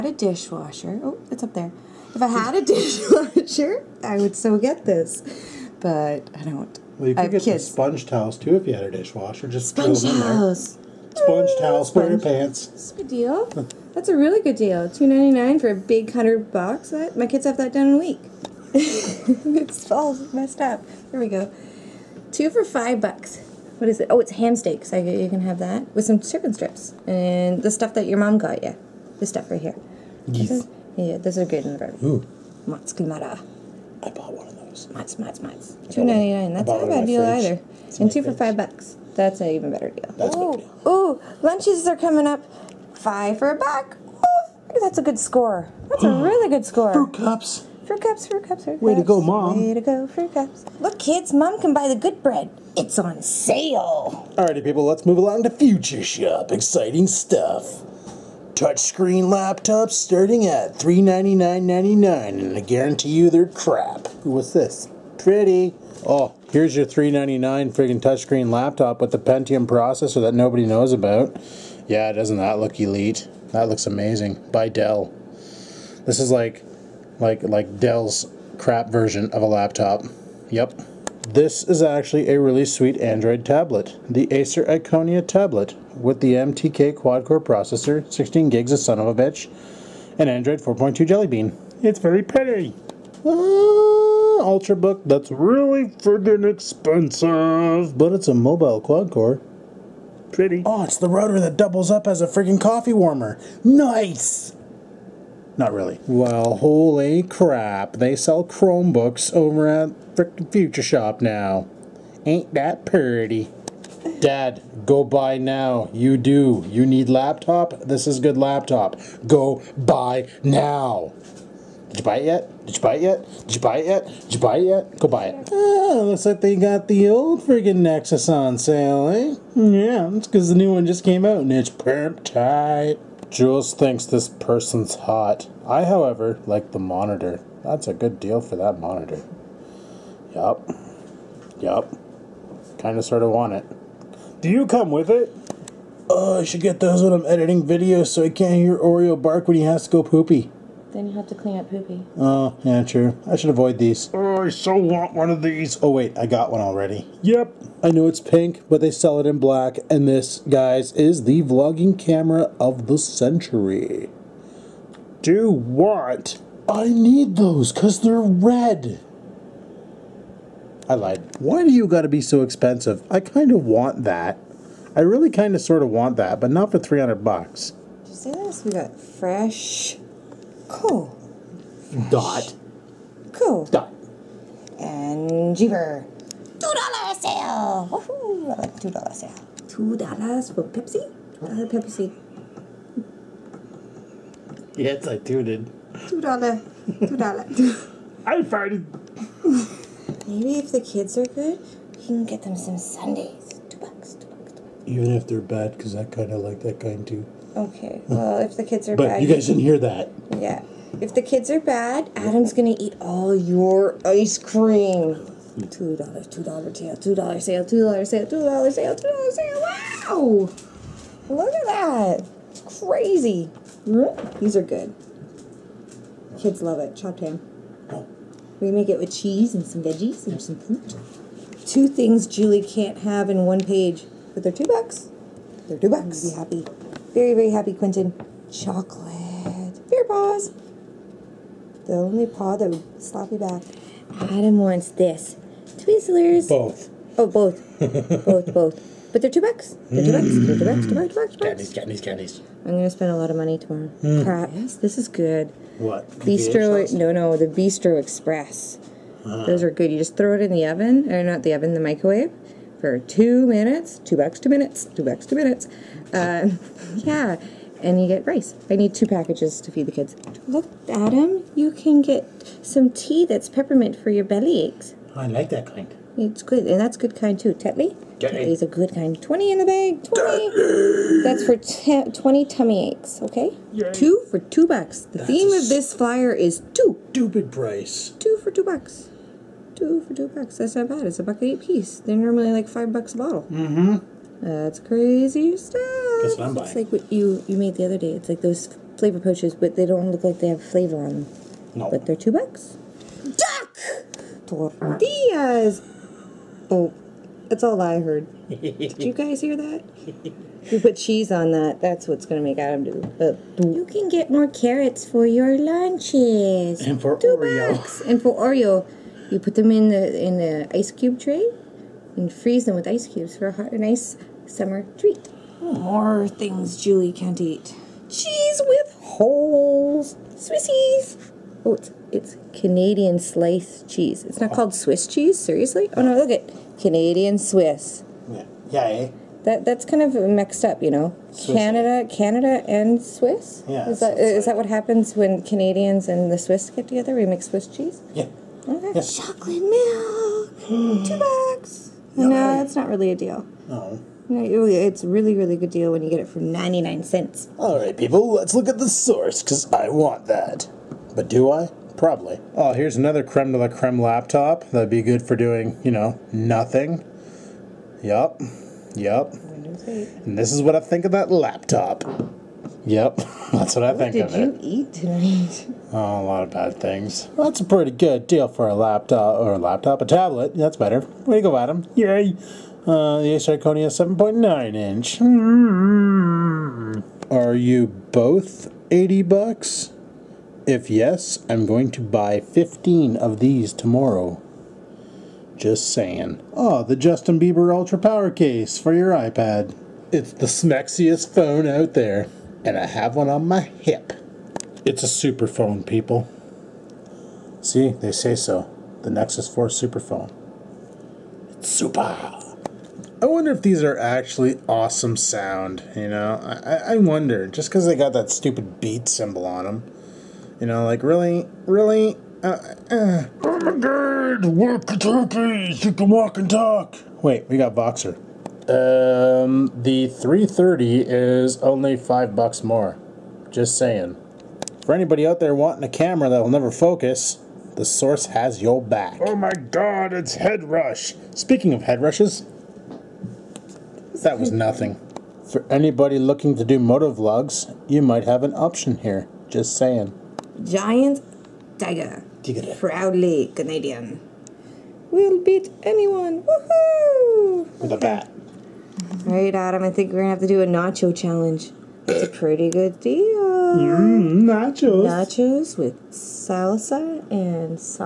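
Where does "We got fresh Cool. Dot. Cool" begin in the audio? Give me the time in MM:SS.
02:58.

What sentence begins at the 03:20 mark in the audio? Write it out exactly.
Maybe if the kids are good, you can get them some sundaes.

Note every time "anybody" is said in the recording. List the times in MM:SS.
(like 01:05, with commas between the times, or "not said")
07:14, 07:25.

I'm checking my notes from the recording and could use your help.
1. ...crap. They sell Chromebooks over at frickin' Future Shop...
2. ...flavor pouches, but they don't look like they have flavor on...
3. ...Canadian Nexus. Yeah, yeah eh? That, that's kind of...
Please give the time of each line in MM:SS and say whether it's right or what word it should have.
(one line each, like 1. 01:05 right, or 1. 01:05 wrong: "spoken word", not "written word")
1. 01:47 right
2. 04:58 right
3. 05:36 wrong: "Swiss", not "Nexus".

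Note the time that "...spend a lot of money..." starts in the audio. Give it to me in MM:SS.
04:12.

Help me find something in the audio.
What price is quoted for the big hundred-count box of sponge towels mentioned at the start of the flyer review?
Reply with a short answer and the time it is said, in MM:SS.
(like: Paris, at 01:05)
$2.99, at 00:14.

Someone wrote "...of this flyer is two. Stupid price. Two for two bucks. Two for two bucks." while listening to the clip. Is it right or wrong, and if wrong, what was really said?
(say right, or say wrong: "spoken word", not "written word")
right.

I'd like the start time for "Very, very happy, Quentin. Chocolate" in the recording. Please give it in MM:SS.
03:57.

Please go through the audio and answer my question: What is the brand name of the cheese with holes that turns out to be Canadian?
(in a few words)
Swissies.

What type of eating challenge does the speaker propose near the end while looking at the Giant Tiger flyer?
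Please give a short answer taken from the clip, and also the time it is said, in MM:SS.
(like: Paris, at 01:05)
nacho challenge, at 07:40.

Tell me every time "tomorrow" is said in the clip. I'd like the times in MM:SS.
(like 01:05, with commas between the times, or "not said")
04:13, 06:33.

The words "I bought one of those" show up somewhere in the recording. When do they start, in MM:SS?
00:34.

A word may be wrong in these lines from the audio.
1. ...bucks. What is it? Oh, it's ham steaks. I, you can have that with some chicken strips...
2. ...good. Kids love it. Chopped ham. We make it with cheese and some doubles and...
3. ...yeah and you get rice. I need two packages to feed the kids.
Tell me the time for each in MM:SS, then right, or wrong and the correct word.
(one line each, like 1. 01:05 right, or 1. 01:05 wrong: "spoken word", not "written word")
1. 00:22 right
2. 03:44 wrong: "veggies", not "doubles"
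3. 04:26 right.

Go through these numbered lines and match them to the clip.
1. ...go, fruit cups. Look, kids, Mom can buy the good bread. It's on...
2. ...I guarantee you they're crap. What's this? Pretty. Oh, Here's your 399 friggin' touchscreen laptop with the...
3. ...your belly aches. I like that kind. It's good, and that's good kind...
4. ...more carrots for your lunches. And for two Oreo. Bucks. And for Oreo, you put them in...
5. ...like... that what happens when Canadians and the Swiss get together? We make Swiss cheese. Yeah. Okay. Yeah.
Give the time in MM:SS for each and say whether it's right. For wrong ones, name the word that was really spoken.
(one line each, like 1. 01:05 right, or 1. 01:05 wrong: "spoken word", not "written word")
1. 00:49 right
2. 01:02 right
3. 04:34 right
4. 05:14 right
5. 05:44 right.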